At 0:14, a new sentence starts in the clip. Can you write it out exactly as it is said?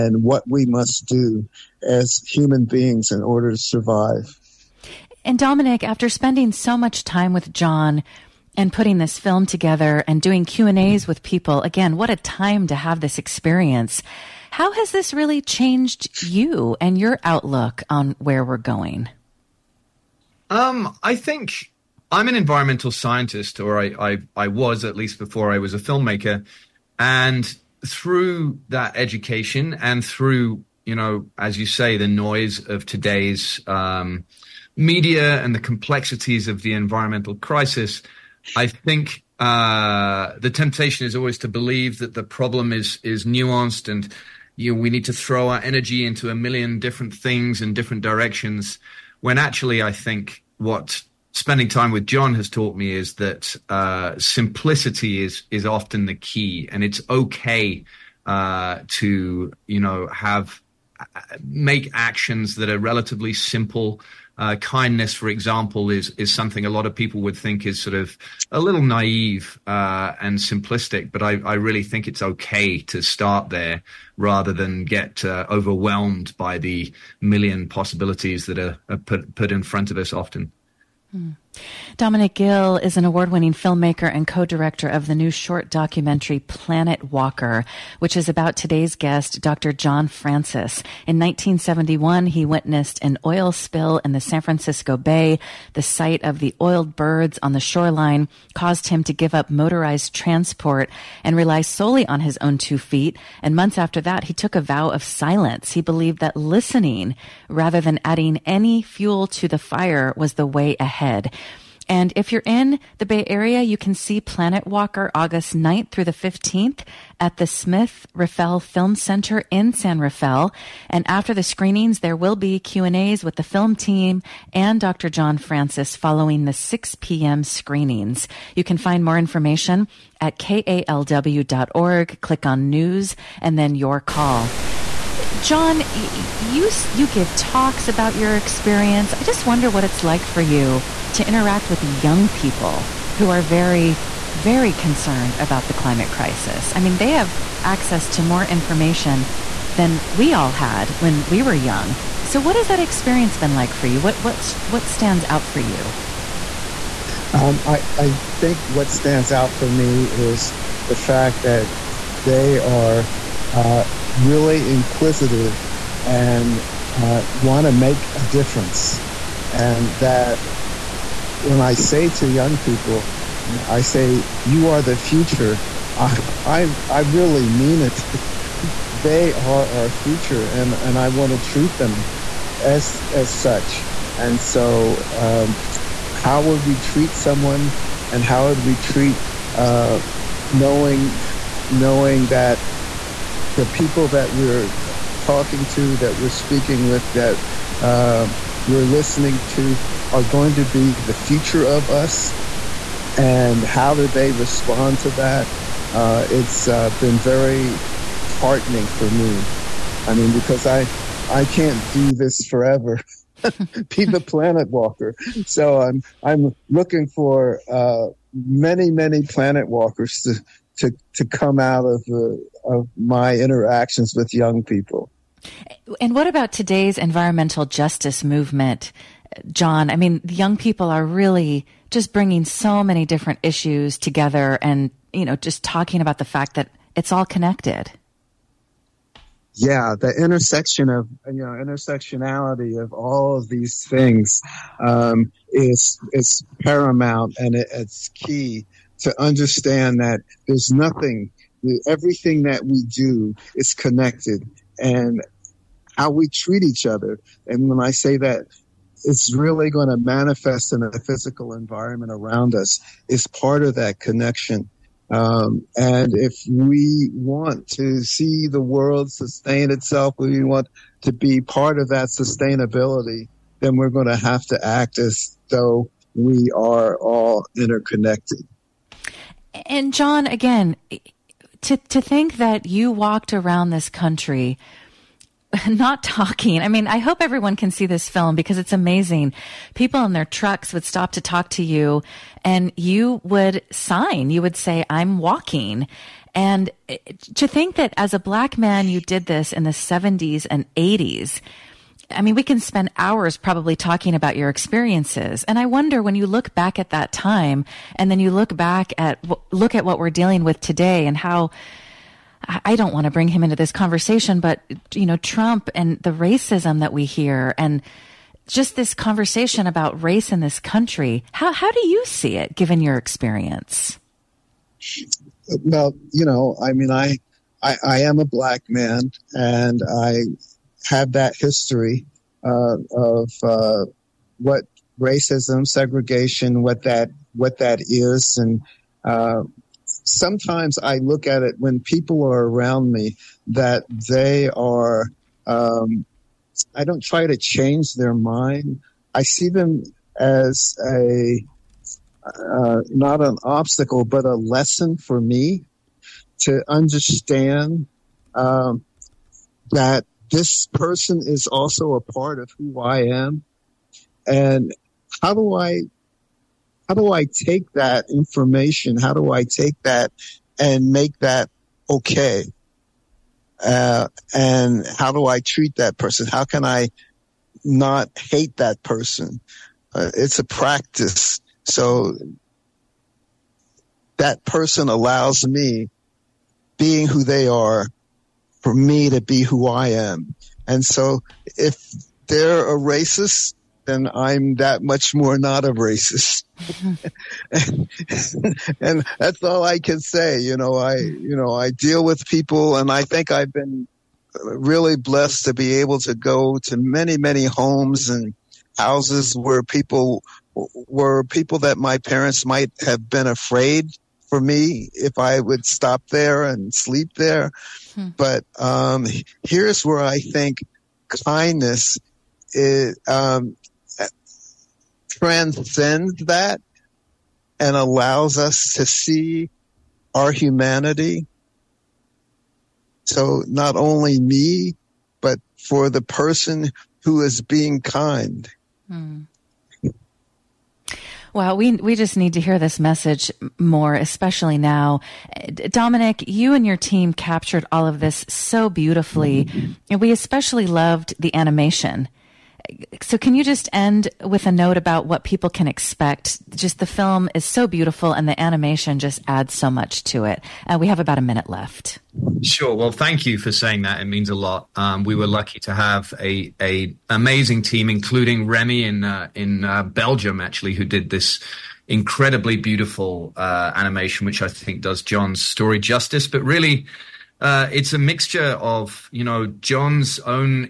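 How has this really changed you and your outlook on where we're going?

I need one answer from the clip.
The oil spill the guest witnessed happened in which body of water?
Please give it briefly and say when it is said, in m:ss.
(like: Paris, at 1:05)
San Francisco Bay, at 1:34.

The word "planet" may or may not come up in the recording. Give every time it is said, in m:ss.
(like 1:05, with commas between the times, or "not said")
1:26, 1:54, 3:34, 3:39.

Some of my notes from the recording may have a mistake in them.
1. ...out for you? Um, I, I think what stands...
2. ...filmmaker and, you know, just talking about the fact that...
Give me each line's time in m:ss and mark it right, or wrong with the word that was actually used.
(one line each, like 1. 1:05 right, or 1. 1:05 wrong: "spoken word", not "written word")
1. 2:35 right
2. 3:53 wrong: "together", not "filmmaker".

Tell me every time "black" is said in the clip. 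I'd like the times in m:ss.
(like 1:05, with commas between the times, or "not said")
4:58, 5:28.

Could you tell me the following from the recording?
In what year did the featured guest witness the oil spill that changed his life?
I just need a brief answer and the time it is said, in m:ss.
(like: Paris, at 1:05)
1971, at 1:31.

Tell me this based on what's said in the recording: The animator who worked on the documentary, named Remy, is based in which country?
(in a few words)
Belgium.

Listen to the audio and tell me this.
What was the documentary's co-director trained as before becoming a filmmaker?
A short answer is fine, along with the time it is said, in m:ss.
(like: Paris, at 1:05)
Environmental scientist, at 0:22.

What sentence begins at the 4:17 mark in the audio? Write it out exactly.
And when I say that, it's really going to manifest in the physical environment around us is part of that connection.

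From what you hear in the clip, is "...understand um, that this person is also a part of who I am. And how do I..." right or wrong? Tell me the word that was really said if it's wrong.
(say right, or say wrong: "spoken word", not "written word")
right.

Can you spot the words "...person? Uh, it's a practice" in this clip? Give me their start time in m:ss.
6:18.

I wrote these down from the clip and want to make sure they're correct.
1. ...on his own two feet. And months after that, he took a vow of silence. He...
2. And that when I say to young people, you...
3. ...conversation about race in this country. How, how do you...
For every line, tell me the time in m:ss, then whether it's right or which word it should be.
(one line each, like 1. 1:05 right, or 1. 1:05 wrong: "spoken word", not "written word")
1. 1:42 right
2. 2:49 right
3. 5:18 right.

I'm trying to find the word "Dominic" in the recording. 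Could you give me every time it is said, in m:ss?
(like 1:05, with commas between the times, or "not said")
0:05, 1:21, 7:25.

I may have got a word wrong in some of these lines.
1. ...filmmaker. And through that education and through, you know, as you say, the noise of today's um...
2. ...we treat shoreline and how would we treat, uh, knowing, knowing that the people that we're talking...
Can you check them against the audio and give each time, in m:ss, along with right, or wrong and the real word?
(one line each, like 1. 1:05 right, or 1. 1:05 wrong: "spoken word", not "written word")
1. 0:25 right
2. 3:06 wrong: "someone", not "shoreline".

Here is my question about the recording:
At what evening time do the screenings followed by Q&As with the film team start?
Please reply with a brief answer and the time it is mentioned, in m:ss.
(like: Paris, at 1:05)
6 p.m., at 2:06.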